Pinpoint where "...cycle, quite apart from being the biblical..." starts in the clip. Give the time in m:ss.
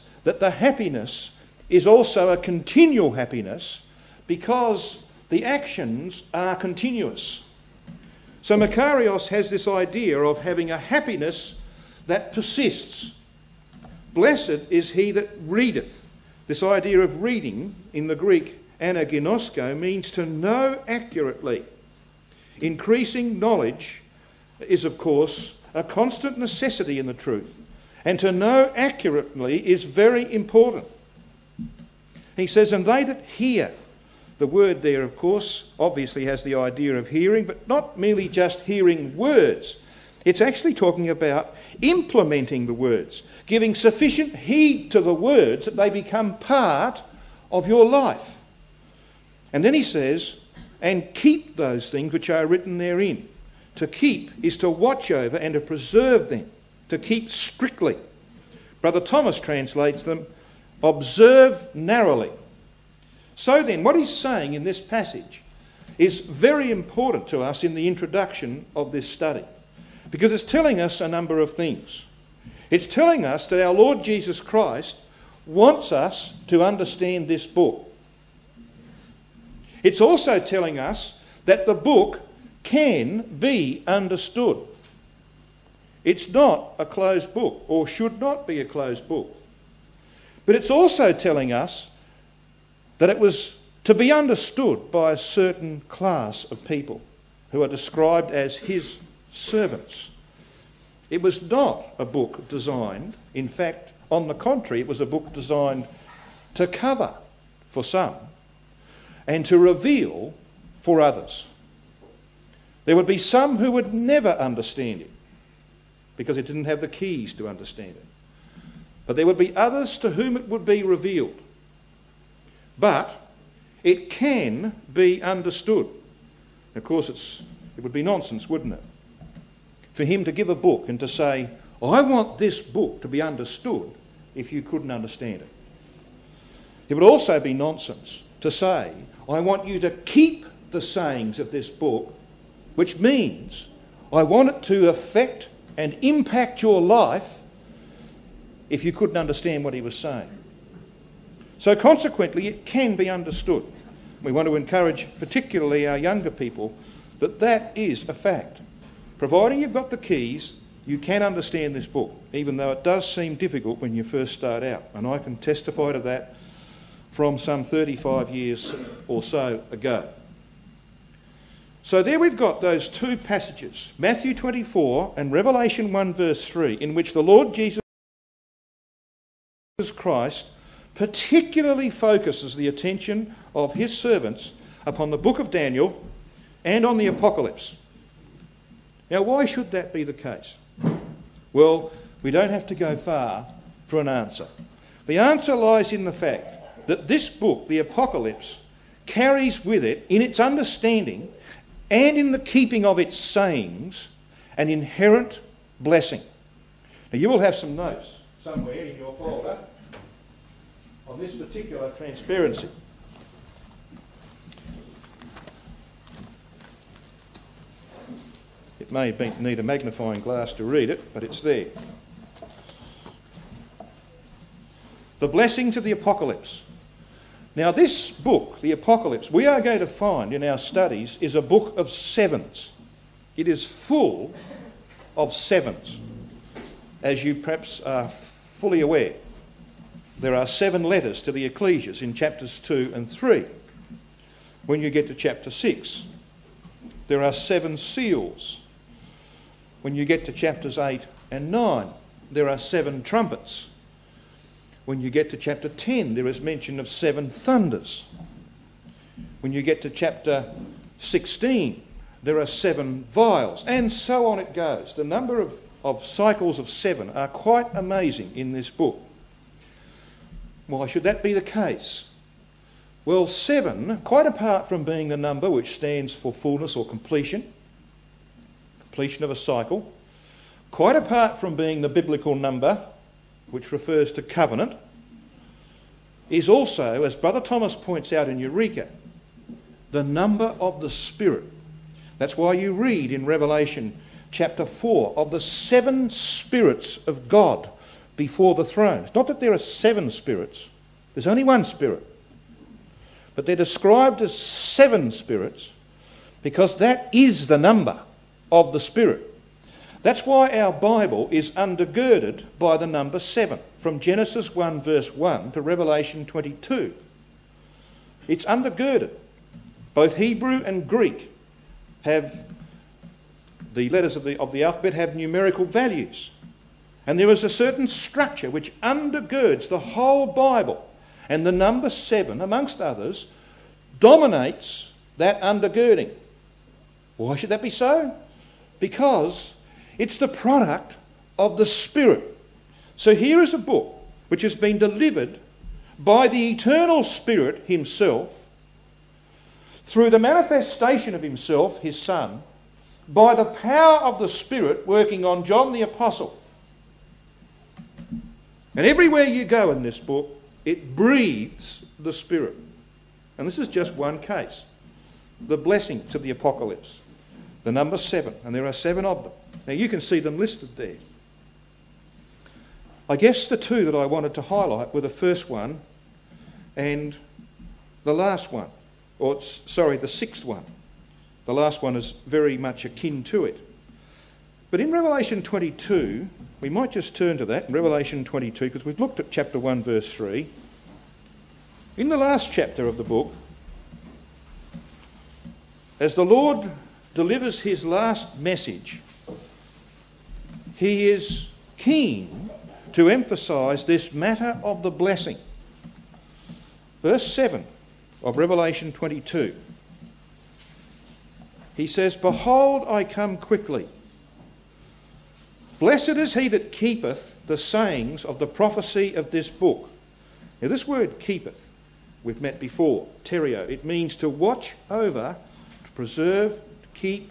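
4:39.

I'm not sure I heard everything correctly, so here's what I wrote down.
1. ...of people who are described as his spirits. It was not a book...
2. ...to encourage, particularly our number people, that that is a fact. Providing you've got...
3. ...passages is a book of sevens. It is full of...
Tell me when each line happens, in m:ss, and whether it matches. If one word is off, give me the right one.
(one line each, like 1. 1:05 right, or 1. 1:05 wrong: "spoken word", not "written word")
1. 1:36 wrong: "servants", not "spirits"
2. 2:34 wrong: "younger", not "number"
3. 3:50 wrong: "studies", not "passages".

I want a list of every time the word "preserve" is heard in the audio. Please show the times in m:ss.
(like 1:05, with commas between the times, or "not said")
0:55, 7:05.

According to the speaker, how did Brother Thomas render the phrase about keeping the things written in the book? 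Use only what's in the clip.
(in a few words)
observe narrowly.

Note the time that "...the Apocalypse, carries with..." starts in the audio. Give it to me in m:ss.
3:17.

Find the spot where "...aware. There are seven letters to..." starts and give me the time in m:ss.
3:58.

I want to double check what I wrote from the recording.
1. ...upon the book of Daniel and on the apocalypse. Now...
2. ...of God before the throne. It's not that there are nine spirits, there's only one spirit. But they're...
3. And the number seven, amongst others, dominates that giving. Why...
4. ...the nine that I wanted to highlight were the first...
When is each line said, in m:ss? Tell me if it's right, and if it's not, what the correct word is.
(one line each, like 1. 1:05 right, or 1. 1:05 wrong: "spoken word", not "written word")
1. 3:04 right
2. 4:57 wrong: "seven", not "nine"
3. 5:31 wrong: "undergirding", not "giving"
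4. 6:13 wrong: "two", not "nine".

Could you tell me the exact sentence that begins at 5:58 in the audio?
And everywhere you go in this book, it breathes the Spirit.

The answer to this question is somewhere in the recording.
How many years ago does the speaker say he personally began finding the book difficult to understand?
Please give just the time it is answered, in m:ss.
2:47.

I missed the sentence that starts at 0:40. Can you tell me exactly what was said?
It's actually talking about implementing the words, giving sufficient heed to the words that they become part of your life.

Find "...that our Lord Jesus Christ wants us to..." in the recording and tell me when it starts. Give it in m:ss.
1:13.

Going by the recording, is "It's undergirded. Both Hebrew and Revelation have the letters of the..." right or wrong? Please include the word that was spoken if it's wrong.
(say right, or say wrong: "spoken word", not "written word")
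wrong: "Greek", not "Revelation".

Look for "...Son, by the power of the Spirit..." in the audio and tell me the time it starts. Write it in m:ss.
5:52.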